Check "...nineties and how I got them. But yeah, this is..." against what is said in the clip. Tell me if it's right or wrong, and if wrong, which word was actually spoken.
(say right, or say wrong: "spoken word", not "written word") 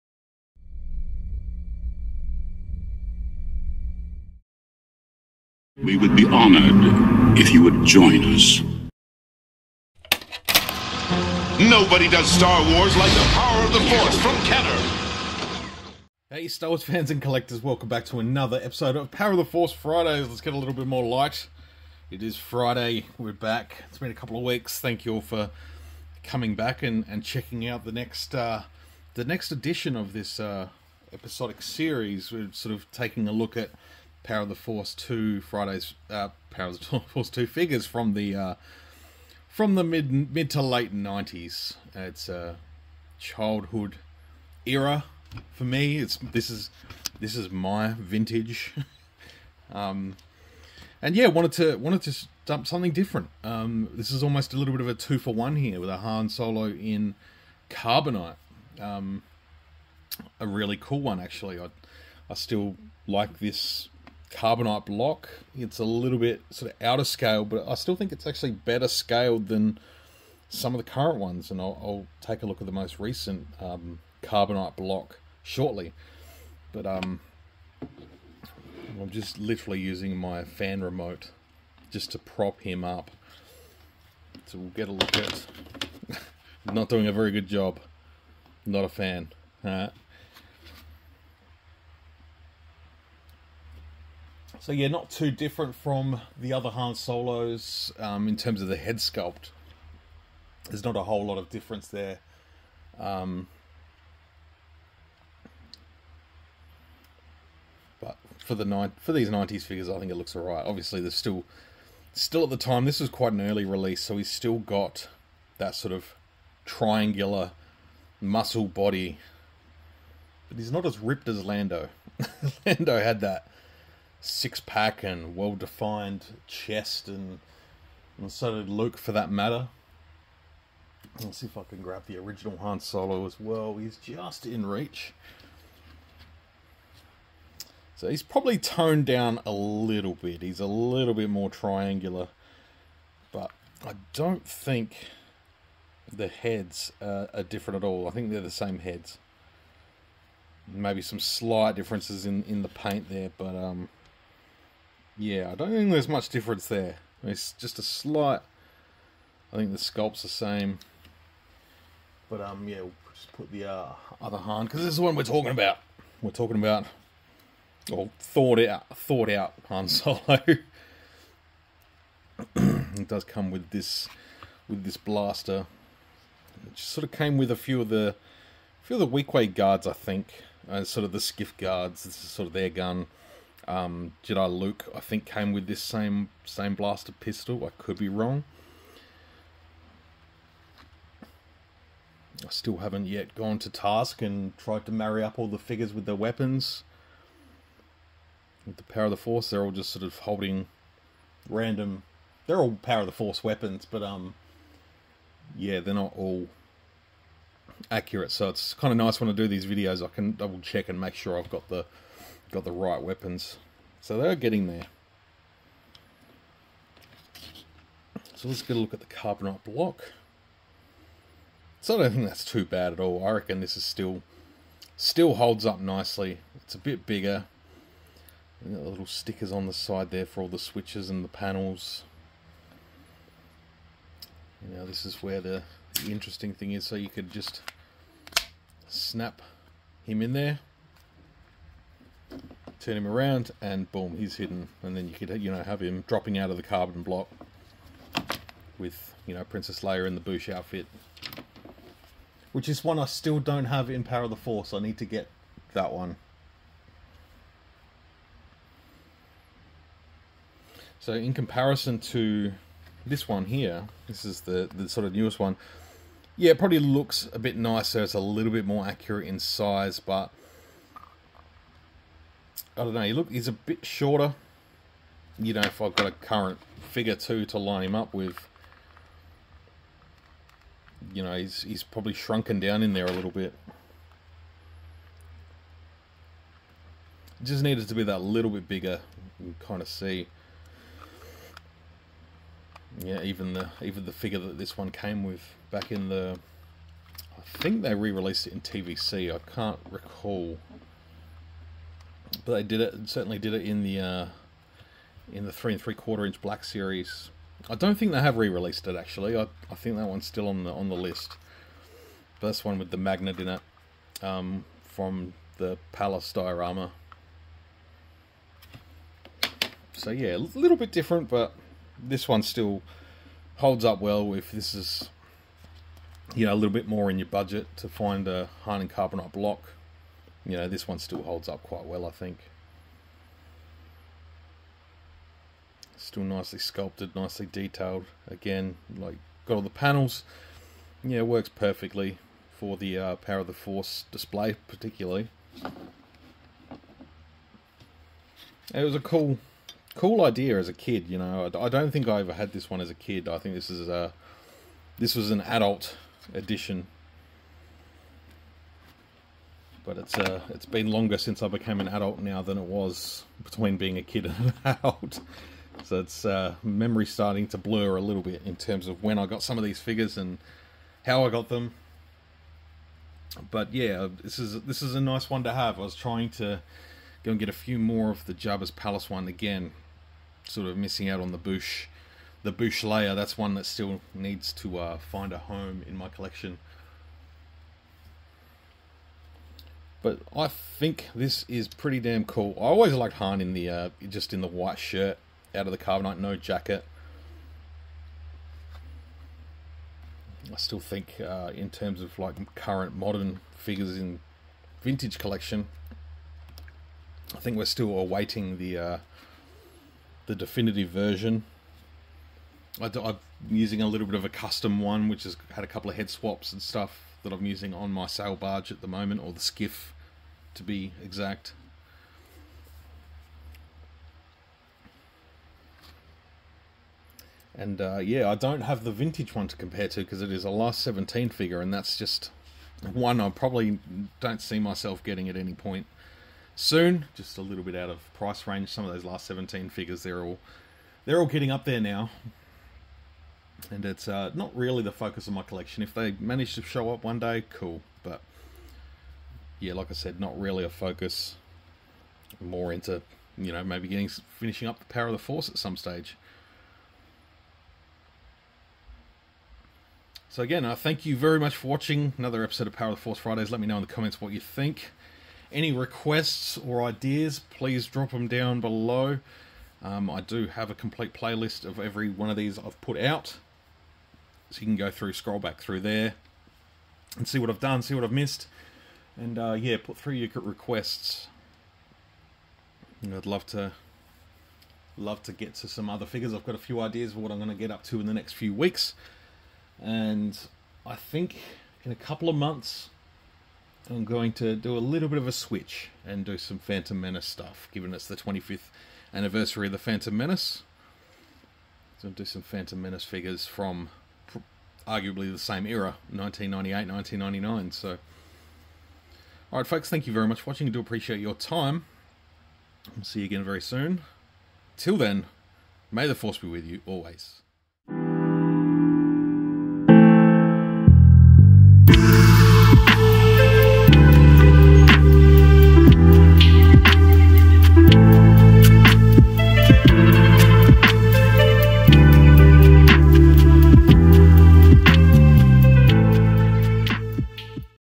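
wrong: "figures", not "nineties".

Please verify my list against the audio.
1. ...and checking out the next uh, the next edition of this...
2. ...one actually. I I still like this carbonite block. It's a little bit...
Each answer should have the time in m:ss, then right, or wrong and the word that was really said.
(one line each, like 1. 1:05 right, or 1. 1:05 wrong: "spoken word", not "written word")
1. 0:27 right
2. 1:01 right.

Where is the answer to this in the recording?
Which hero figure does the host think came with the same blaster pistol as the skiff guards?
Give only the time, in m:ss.
3:04.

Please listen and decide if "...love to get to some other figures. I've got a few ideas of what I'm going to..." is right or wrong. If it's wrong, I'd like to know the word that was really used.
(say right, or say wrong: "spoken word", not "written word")
right.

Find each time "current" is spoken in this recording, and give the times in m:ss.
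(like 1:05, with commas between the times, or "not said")
1:10, 4:36, 6:42.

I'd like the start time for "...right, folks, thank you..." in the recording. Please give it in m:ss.
8:29.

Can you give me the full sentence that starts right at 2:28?
I think they're the same heads.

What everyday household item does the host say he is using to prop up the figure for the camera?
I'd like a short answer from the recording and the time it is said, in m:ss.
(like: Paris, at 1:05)
fan remote, at 1:20.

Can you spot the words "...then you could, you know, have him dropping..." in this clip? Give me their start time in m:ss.
4:04.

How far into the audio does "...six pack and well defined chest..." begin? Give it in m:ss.
2:04.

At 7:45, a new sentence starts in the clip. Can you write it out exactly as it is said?
Any requests or ideas, please drop them down below.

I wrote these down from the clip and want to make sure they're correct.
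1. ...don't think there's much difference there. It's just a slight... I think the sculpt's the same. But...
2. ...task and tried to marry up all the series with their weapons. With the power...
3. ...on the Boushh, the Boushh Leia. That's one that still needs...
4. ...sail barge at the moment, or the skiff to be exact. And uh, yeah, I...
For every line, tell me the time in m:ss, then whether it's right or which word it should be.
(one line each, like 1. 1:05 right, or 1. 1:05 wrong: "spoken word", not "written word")
1. 2:35 right
2. 3:13 wrong: "figures", not "series"
3. 6:21 right
4. 6:58 right.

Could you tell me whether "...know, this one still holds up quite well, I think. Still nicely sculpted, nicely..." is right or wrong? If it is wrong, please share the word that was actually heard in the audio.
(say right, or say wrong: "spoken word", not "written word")
right.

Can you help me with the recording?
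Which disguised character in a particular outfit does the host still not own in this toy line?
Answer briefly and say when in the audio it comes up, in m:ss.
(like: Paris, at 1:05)
Princess Leia, at 4:09.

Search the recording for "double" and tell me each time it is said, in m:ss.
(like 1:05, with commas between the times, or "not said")
3:30.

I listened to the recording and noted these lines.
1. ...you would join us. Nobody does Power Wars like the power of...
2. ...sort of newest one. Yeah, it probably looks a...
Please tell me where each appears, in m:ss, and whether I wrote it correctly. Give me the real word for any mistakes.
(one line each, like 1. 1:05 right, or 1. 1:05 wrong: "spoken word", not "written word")
1. 0:07 wrong: "Star", not "Power"
2. 4:24 right.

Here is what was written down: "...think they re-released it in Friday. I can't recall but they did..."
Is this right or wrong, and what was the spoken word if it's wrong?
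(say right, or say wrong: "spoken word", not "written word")
wrong: "TVC", not "Friday".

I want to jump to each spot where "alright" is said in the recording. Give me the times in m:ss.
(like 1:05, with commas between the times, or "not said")
1:50.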